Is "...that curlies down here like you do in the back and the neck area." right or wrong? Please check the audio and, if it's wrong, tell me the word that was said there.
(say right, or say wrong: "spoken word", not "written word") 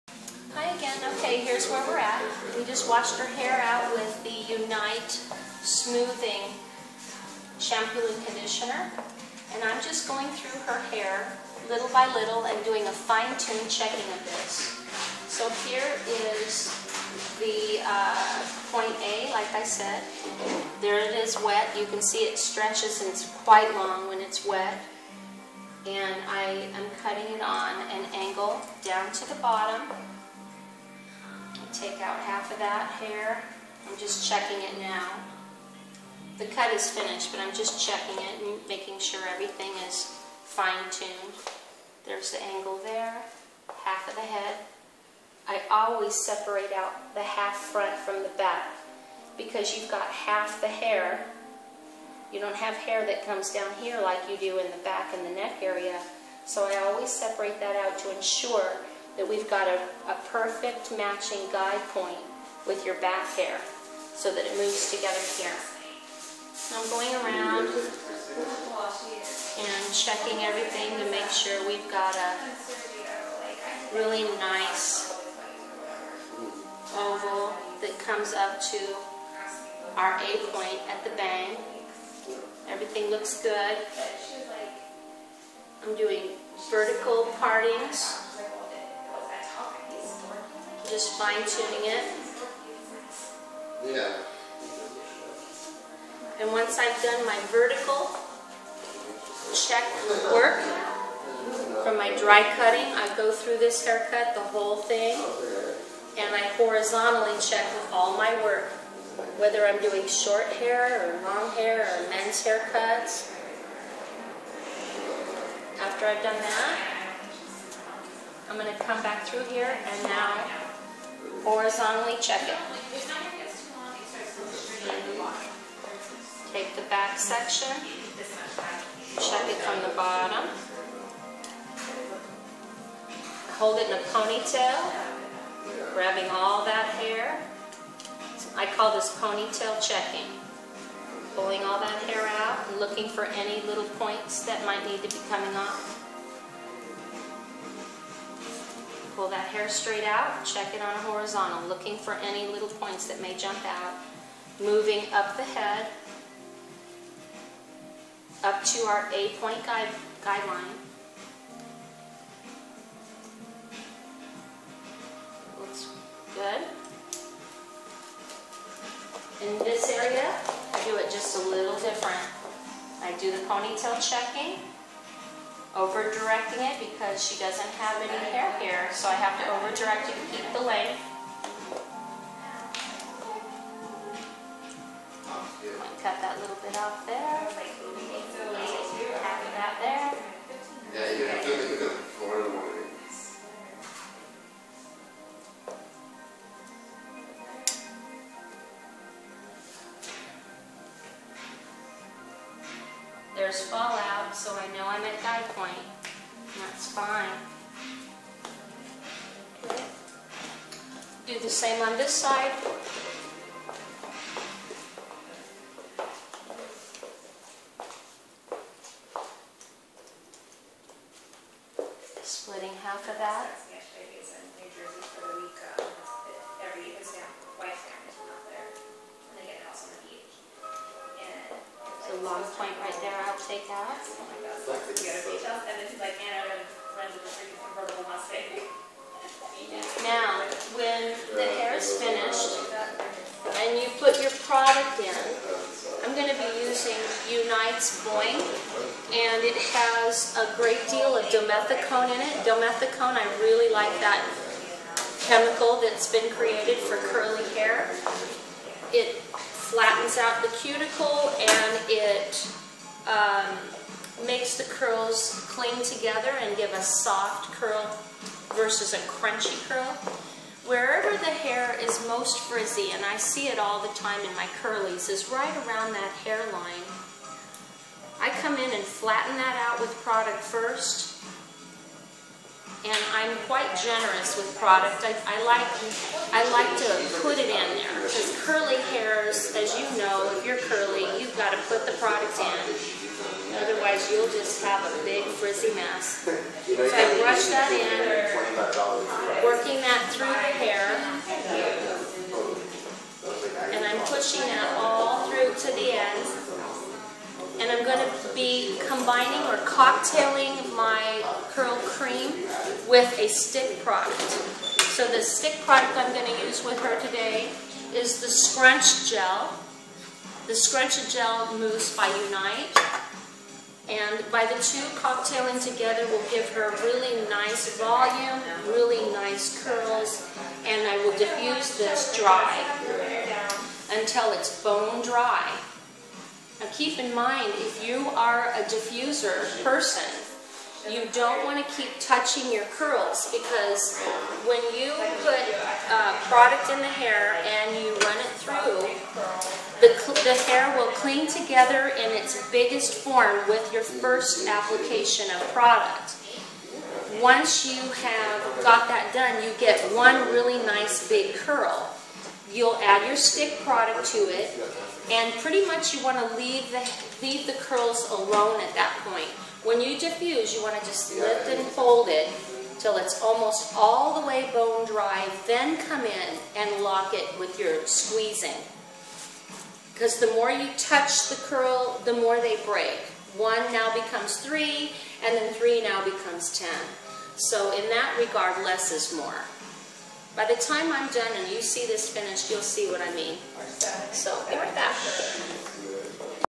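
wrong: "comes", not "curlies".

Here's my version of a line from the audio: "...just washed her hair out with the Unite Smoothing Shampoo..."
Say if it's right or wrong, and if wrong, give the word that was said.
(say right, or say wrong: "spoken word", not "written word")
right.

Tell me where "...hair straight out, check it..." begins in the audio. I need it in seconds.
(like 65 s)
149 s.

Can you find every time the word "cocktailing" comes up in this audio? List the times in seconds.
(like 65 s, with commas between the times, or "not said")
309 s, 324 s.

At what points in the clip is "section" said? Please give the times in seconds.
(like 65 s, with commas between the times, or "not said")
127 s.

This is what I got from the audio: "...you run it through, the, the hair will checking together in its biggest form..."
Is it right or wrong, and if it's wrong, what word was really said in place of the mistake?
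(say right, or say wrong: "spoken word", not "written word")
wrong: "cling", not "checking".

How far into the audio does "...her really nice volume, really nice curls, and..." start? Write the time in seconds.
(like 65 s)
326 s.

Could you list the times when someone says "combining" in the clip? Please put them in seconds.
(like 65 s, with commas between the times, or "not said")
308 s.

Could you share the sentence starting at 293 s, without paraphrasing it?
Otherwise, you'll just have a big frizzy mess.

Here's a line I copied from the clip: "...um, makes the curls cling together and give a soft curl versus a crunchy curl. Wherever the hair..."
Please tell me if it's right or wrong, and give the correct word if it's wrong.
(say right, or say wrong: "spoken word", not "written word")
right.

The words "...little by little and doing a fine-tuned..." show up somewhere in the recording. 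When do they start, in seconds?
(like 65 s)
11 s.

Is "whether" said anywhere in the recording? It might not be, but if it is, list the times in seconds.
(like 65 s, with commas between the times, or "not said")
109 s.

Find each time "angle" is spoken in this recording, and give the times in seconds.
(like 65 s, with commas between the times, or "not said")
28 s, 42 s.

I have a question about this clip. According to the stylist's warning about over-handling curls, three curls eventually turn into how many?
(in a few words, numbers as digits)
10.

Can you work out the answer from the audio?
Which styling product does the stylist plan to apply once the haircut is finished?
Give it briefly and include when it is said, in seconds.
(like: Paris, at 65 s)
Boing, at 248 s.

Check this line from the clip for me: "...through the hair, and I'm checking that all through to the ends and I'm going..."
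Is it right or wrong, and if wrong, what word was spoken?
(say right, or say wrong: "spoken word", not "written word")
wrong: "pushing", not "checking".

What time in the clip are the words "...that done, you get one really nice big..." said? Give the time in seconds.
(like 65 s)
358 s.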